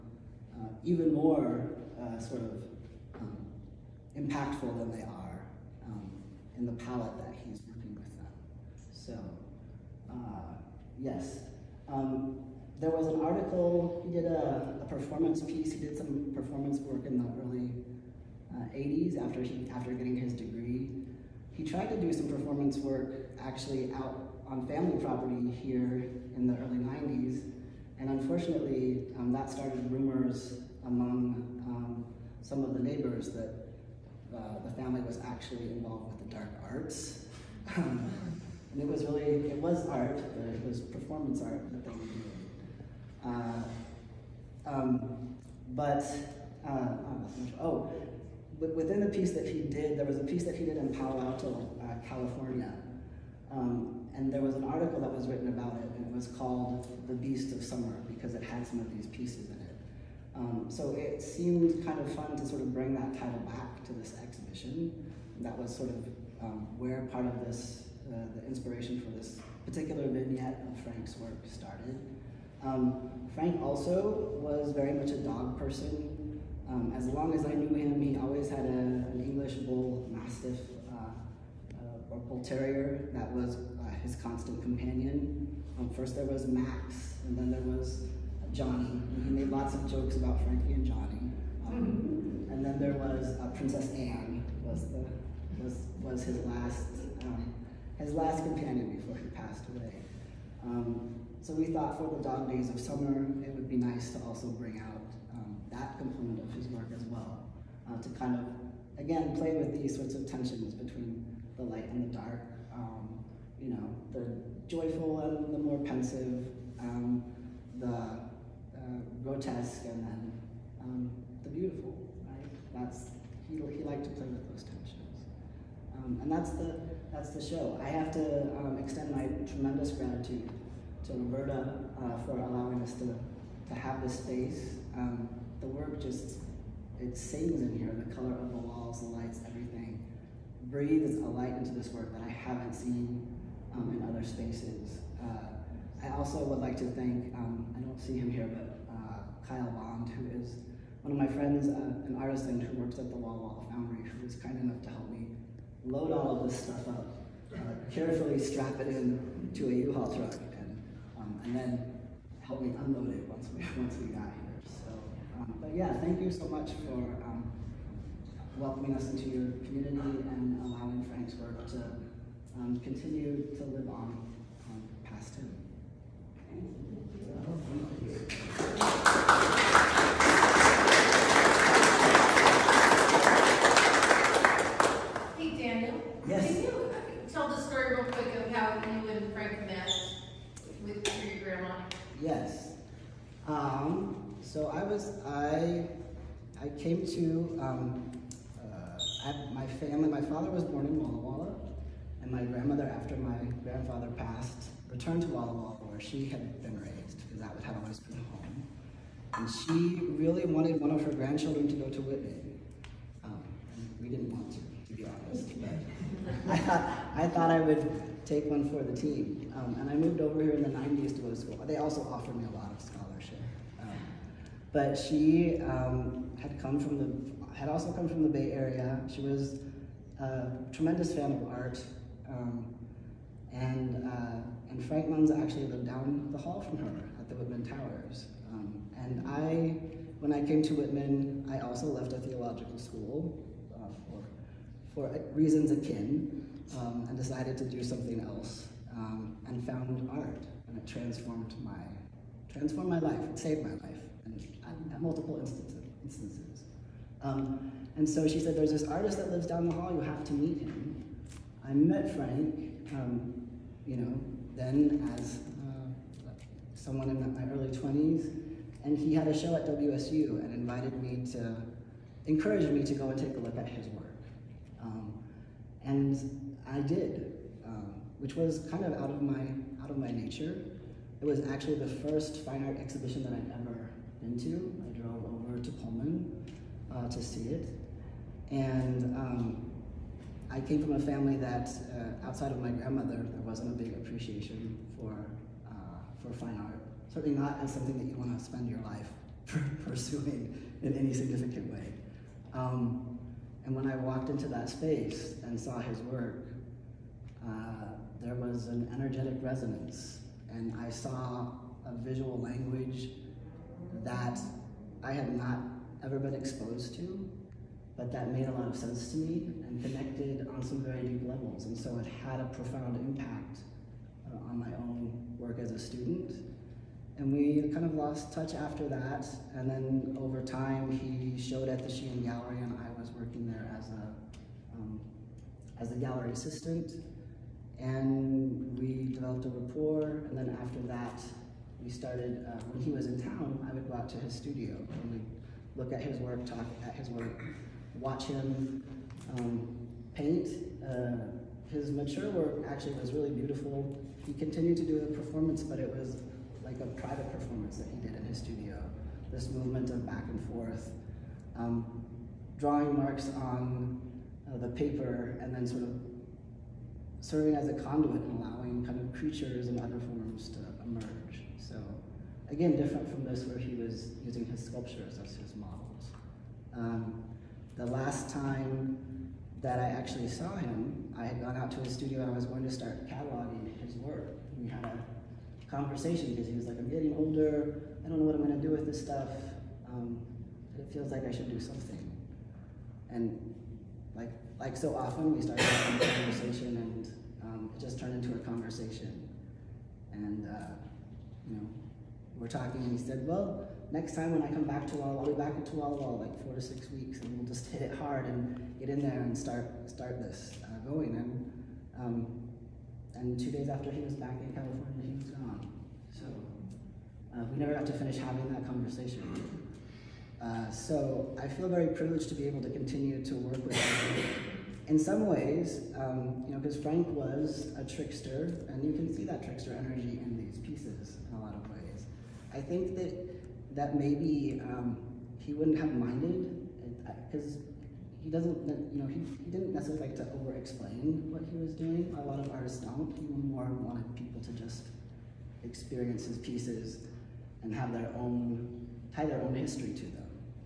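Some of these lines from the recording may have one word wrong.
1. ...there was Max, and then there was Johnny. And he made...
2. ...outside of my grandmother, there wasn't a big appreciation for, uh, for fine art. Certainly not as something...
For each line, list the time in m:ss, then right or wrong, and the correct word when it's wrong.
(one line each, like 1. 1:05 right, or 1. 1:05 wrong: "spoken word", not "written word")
1. 1:26 right
2. 4:52 right.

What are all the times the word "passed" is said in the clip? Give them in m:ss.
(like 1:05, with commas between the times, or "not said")
1:39, 3:24.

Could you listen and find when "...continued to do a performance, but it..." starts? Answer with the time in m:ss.
5:54.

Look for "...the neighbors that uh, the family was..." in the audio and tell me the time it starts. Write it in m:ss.
0:32.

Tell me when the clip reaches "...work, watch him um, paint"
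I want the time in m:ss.
5:47.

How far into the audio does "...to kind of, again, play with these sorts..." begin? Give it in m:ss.
1:48.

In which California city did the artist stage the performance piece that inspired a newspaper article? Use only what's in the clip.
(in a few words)
Palo Alto.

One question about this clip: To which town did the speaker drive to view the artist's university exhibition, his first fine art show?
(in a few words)
Pullman.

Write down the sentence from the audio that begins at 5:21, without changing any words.
And so it had a profound impact uh, on my own work as a student.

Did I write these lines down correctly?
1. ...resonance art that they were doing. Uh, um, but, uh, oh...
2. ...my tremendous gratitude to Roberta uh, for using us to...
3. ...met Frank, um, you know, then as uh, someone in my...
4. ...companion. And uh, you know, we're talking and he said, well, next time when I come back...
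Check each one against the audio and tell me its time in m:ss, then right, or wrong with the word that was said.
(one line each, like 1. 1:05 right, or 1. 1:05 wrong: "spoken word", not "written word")
1. 0:40 wrong: "performance", not "resonance"
2. 2:09 wrong: "allowing", not "using"
3. 4:21 right
4. 6:38 wrong: "conversation", not "companion".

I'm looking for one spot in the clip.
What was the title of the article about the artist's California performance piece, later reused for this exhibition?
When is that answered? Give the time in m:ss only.
0:57.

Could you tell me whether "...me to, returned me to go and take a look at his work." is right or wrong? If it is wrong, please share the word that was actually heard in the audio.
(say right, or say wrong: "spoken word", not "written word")
wrong: "encouraged", not "returned".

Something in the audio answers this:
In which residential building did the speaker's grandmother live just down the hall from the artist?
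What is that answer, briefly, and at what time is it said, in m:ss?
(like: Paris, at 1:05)
Whitman Towers, at 3:57.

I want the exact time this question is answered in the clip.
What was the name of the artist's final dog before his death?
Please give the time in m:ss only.
1:33.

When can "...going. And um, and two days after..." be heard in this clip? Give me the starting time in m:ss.
6:50.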